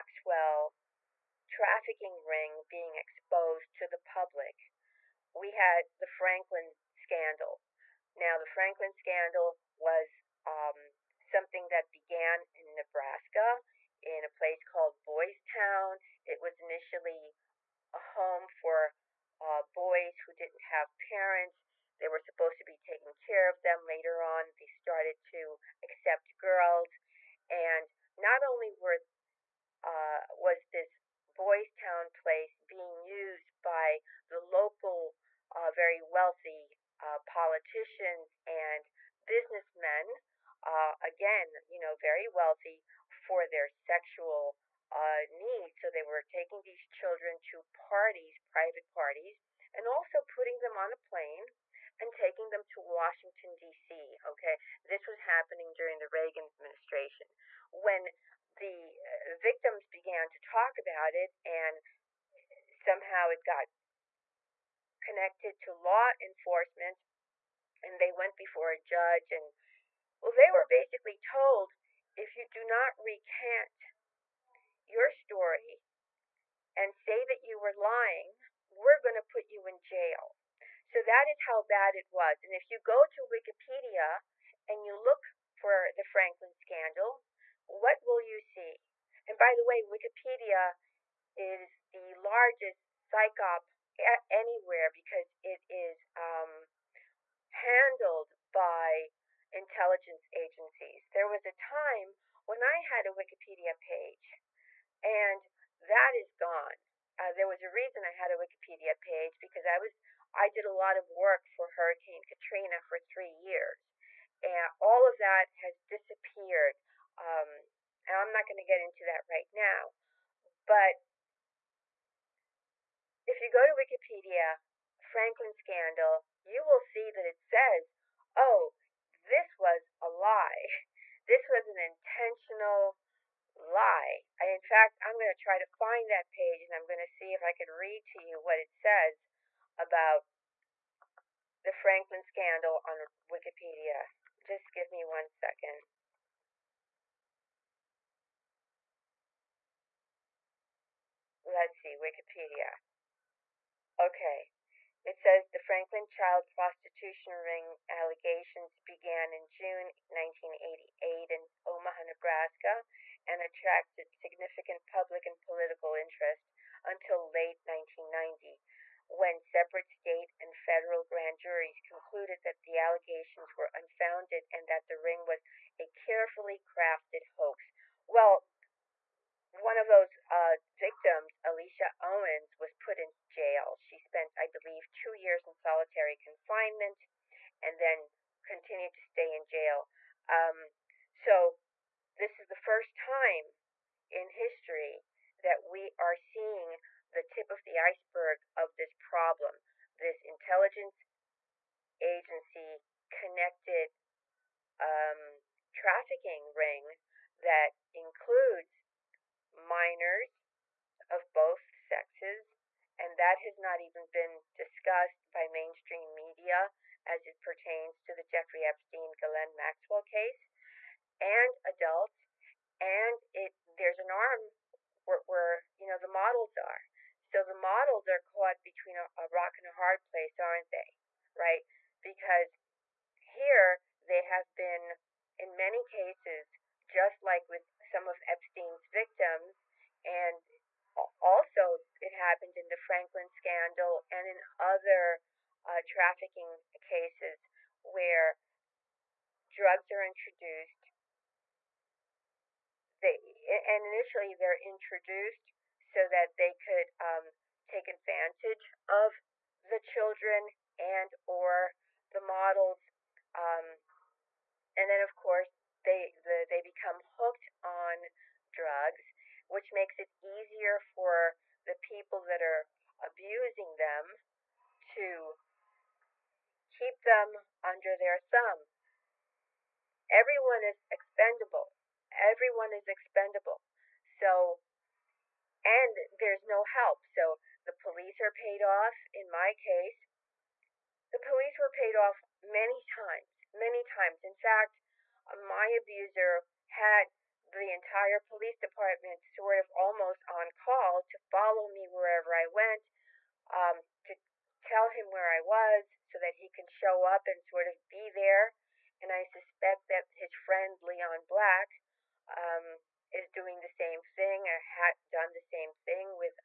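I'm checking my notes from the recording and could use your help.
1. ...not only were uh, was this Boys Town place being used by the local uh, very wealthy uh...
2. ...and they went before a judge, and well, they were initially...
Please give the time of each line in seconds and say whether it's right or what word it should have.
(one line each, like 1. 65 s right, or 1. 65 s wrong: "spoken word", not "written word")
1. 28 s right
2. 67 s wrong: "basically", not "initially".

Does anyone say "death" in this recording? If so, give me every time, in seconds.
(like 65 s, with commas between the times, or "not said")
not said.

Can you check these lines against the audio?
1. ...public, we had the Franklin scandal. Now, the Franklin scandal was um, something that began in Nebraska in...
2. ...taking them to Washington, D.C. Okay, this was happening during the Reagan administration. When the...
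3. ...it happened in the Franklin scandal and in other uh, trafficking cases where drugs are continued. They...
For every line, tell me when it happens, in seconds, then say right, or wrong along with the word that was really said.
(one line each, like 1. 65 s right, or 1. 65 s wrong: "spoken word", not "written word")
1. 3 s right
2. 52 s right
3. 241 s wrong: "introduced", not "continued".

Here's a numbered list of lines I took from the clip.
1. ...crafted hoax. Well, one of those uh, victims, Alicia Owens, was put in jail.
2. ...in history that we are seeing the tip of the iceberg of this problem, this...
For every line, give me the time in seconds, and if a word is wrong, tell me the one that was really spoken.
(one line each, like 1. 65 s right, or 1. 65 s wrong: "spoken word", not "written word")
1. 176 s right
2. 194 s right.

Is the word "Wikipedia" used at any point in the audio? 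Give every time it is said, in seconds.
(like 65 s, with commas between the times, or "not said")
83 s, 89 s, 103 s, 108 s, 123 s, 143 s, 151 s.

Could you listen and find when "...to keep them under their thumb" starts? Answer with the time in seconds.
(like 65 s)
274 s.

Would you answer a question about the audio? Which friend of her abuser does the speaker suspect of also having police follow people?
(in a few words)
Leon Black.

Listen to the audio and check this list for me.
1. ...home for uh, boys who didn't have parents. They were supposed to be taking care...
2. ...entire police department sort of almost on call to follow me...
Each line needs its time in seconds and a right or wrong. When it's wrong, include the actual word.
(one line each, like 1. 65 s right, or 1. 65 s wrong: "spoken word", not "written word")
1. 17 s right
2. 297 s right.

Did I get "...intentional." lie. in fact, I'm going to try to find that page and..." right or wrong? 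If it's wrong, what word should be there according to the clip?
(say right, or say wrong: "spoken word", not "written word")
right.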